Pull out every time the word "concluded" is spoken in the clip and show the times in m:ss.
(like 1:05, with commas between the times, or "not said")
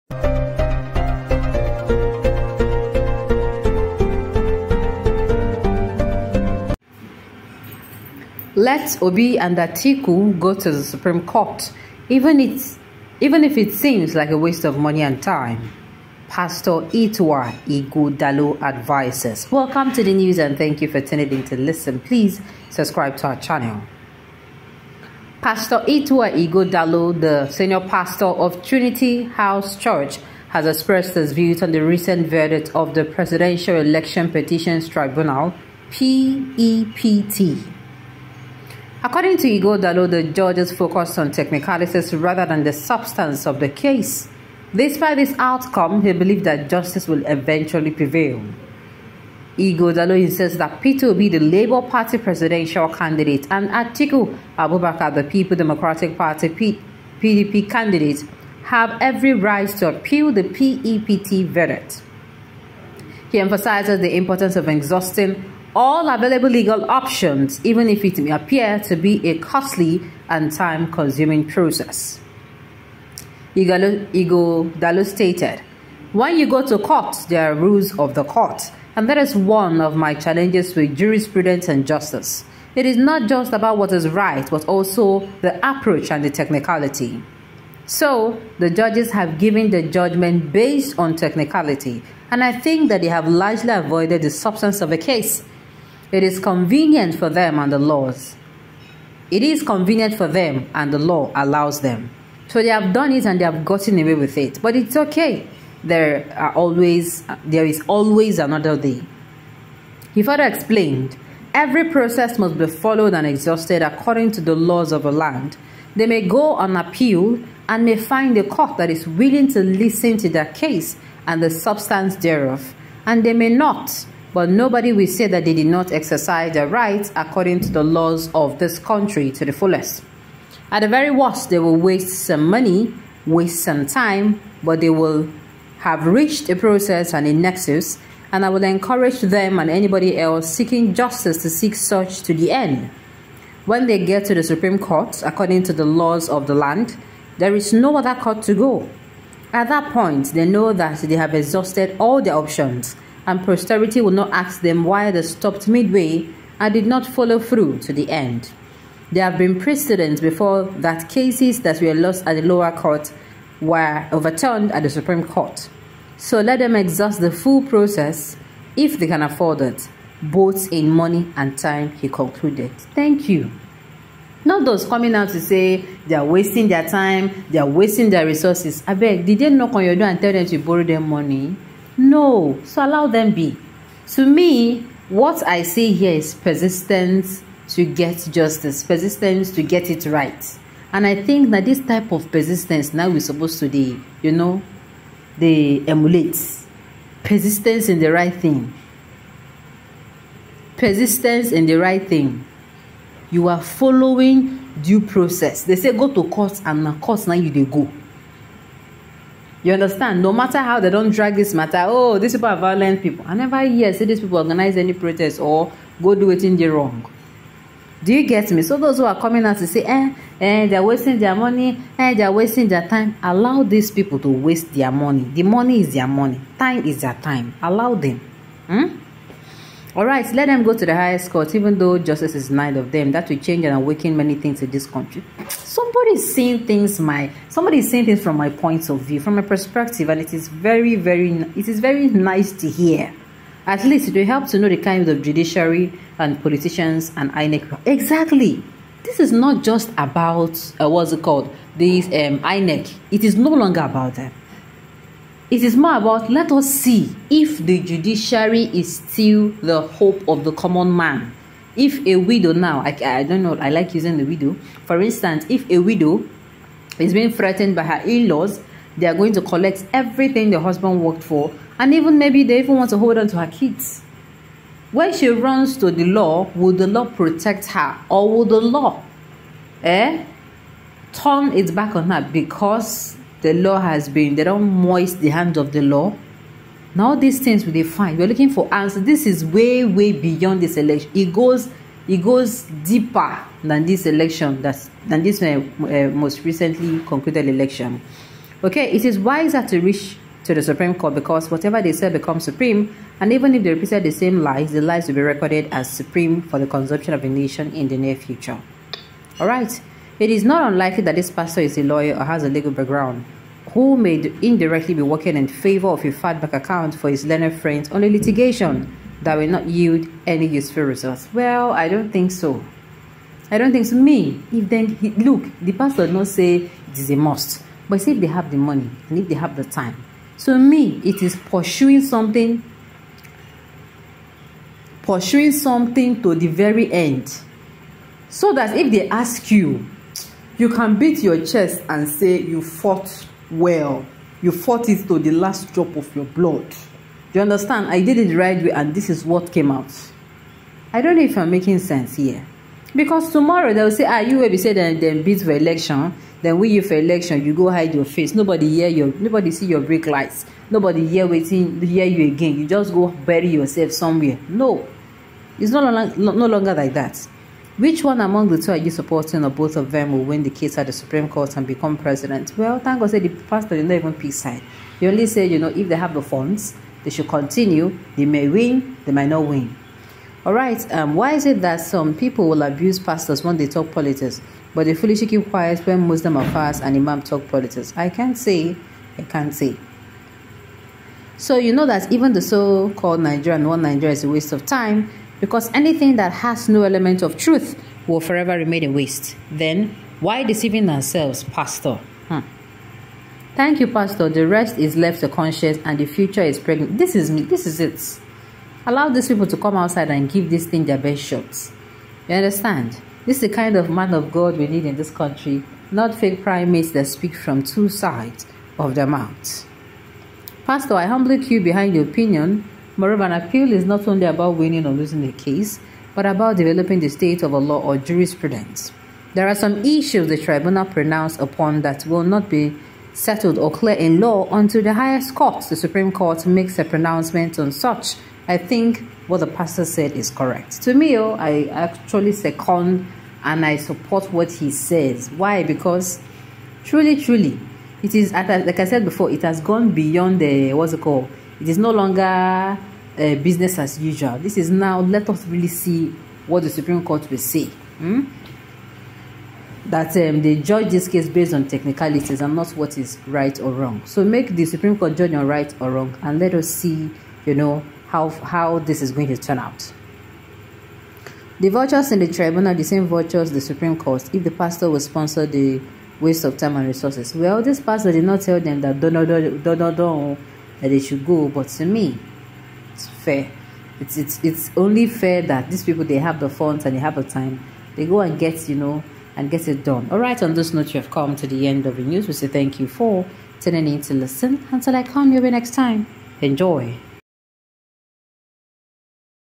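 2:52, 4:57.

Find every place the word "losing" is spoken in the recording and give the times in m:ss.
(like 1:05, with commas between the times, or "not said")
7:04.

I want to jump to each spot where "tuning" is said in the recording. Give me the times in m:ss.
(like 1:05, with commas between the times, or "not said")
0:21, 8:13.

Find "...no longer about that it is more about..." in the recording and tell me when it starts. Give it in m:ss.
4:13.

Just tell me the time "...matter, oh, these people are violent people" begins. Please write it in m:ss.
3:31.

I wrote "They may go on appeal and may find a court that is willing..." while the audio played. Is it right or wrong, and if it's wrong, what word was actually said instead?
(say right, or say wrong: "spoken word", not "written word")
right.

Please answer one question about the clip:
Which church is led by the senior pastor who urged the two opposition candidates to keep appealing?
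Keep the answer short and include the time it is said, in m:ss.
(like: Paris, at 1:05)
Trinity House Church, at 0:28.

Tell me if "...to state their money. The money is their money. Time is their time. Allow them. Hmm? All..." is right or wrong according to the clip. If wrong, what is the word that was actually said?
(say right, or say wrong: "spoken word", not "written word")
wrong: "waste", not "state".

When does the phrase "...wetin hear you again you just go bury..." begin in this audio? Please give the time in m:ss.
6:01.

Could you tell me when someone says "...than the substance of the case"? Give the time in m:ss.
0:42.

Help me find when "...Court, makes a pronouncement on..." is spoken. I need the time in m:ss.
7:16.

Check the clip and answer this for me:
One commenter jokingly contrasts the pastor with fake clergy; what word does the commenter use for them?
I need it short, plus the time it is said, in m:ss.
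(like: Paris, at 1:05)
Primates, at 6:56.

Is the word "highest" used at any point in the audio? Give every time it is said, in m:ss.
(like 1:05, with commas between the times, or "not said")
3:50, 7:14.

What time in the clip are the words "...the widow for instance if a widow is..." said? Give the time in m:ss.
4:24.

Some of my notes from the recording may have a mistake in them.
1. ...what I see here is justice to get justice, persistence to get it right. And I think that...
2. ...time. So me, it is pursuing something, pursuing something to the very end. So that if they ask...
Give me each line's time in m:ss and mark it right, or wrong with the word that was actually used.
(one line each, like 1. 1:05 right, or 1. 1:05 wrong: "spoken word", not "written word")
1. 3:05 wrong: "persistence", not "justice"
2. 5:29 right.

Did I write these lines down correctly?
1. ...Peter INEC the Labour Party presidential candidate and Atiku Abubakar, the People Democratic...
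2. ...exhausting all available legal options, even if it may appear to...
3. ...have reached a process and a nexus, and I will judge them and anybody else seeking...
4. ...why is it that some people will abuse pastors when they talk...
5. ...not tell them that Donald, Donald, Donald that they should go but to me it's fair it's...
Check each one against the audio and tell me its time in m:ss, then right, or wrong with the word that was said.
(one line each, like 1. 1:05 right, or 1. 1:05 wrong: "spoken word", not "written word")
1. 0:50 wrong: "Obi", not "INEC"
2. 1:04 right
3. 2:15 wrong: "encourage", not "judge"
4. 6:21 right
5. 7:58 right.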